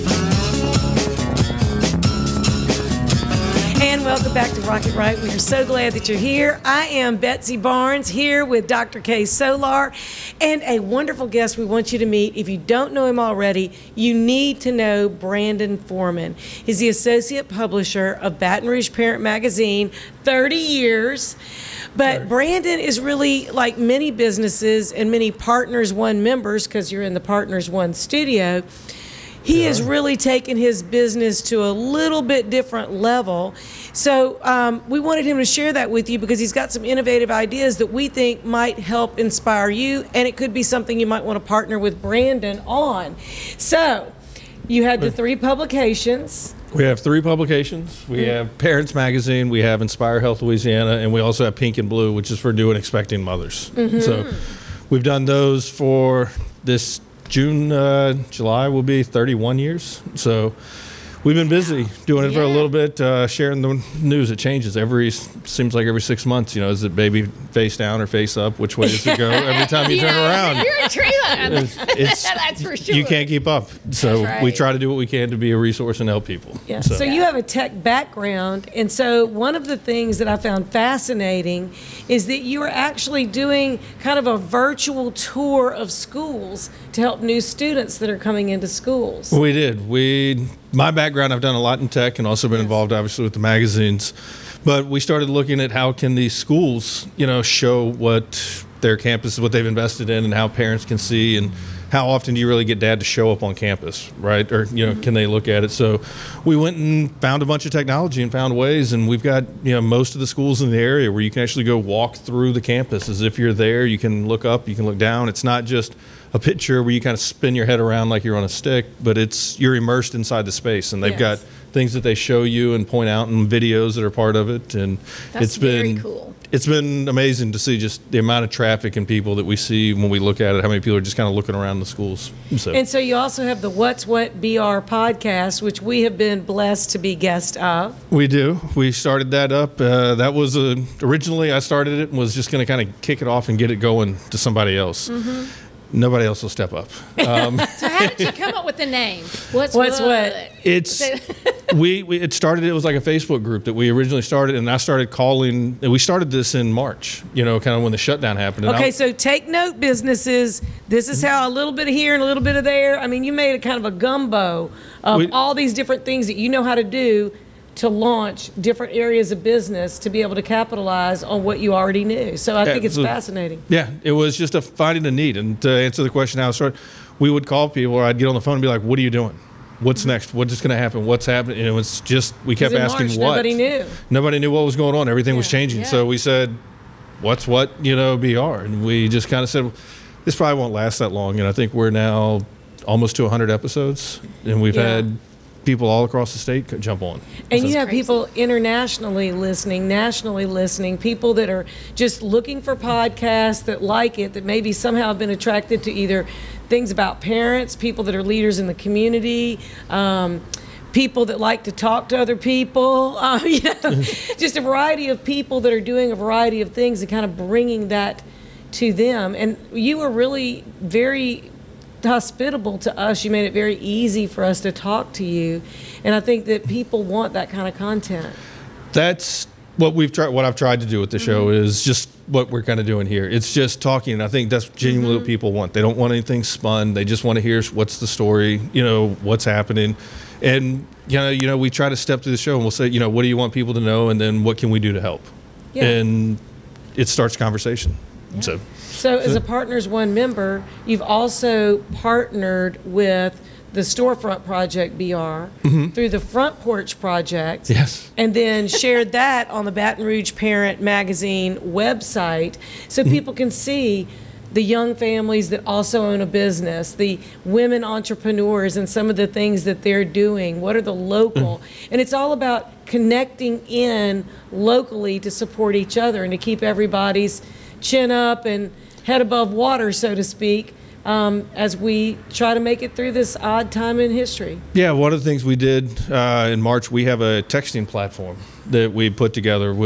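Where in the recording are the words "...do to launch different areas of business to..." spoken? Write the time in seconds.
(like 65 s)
166 s.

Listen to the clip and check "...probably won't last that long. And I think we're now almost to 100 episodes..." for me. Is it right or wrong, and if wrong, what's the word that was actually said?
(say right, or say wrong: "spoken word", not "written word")
right.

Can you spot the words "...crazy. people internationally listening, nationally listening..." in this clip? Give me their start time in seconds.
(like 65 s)
197 s.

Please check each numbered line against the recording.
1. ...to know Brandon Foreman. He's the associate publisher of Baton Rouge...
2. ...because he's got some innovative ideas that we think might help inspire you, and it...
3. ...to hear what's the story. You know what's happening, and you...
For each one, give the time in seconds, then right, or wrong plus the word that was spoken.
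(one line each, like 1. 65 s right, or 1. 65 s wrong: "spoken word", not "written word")
1. 14 s right
2. 36 s right
3. 237 s right.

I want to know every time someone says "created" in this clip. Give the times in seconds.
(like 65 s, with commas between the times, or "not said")
not said.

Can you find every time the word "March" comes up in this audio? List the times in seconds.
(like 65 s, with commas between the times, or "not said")
156 s, 183 s, 286 s.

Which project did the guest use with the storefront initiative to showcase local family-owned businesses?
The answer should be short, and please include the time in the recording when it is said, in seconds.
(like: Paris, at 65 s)
the front porch project, at 256 s.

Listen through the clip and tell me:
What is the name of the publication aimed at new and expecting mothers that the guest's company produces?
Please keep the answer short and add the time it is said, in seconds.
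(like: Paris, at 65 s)
Pink and Blue, at 51 s.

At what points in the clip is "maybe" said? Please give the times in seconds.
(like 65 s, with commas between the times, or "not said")
204 s.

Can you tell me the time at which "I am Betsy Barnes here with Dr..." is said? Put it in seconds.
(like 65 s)
6 s.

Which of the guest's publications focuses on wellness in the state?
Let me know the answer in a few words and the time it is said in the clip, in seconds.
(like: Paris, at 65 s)
Inspire Health Louisiana, at 49 s.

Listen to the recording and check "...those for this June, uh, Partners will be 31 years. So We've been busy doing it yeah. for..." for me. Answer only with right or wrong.
wrong.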